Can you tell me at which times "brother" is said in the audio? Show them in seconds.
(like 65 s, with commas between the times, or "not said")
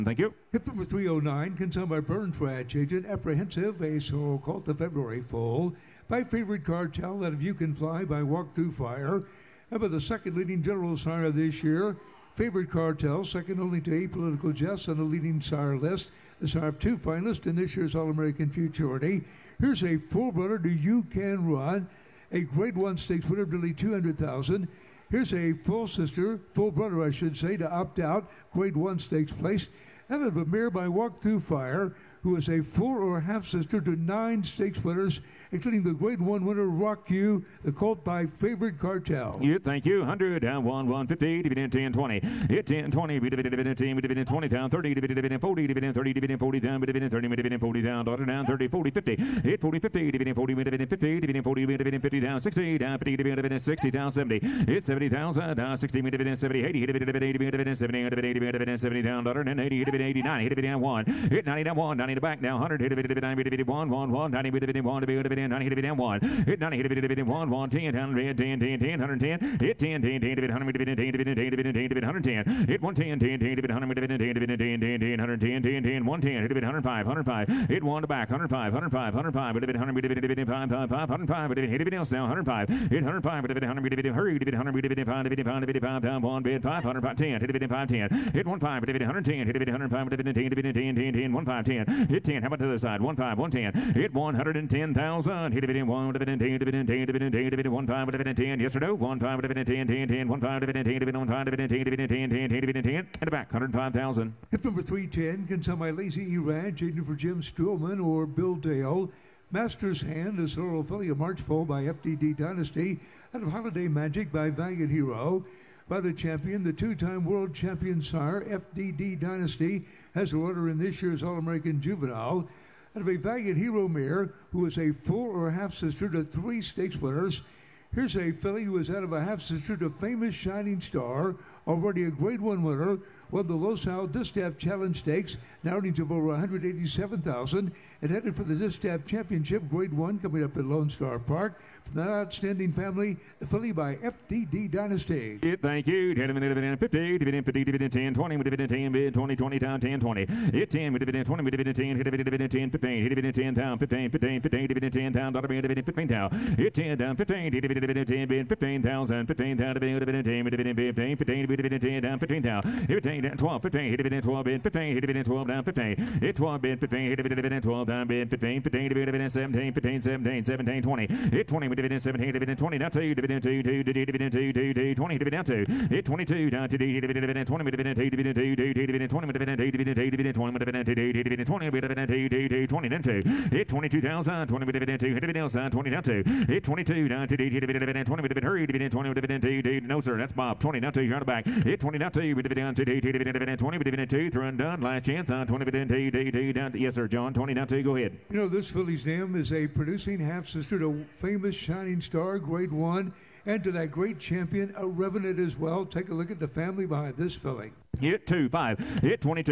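26 s.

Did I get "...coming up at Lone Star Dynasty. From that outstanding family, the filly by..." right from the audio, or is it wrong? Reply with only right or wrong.
wrong.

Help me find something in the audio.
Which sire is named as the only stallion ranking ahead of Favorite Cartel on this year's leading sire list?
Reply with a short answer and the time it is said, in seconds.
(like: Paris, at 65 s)
Apollitical Jess, at 13 s.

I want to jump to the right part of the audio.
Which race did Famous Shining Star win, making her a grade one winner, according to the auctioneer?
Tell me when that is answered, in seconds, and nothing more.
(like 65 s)
133 s.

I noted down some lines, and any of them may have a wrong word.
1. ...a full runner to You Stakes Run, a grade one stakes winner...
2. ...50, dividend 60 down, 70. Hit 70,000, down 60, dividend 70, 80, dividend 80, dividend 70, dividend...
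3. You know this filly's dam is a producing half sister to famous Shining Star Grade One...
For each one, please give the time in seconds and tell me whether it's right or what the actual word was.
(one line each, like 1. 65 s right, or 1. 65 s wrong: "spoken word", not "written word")
1. 19 s wrong: "Can", not "Stakes"
2. 52 s right
3. 198 s right.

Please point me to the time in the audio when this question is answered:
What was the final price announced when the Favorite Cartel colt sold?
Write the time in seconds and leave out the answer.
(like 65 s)
103 s.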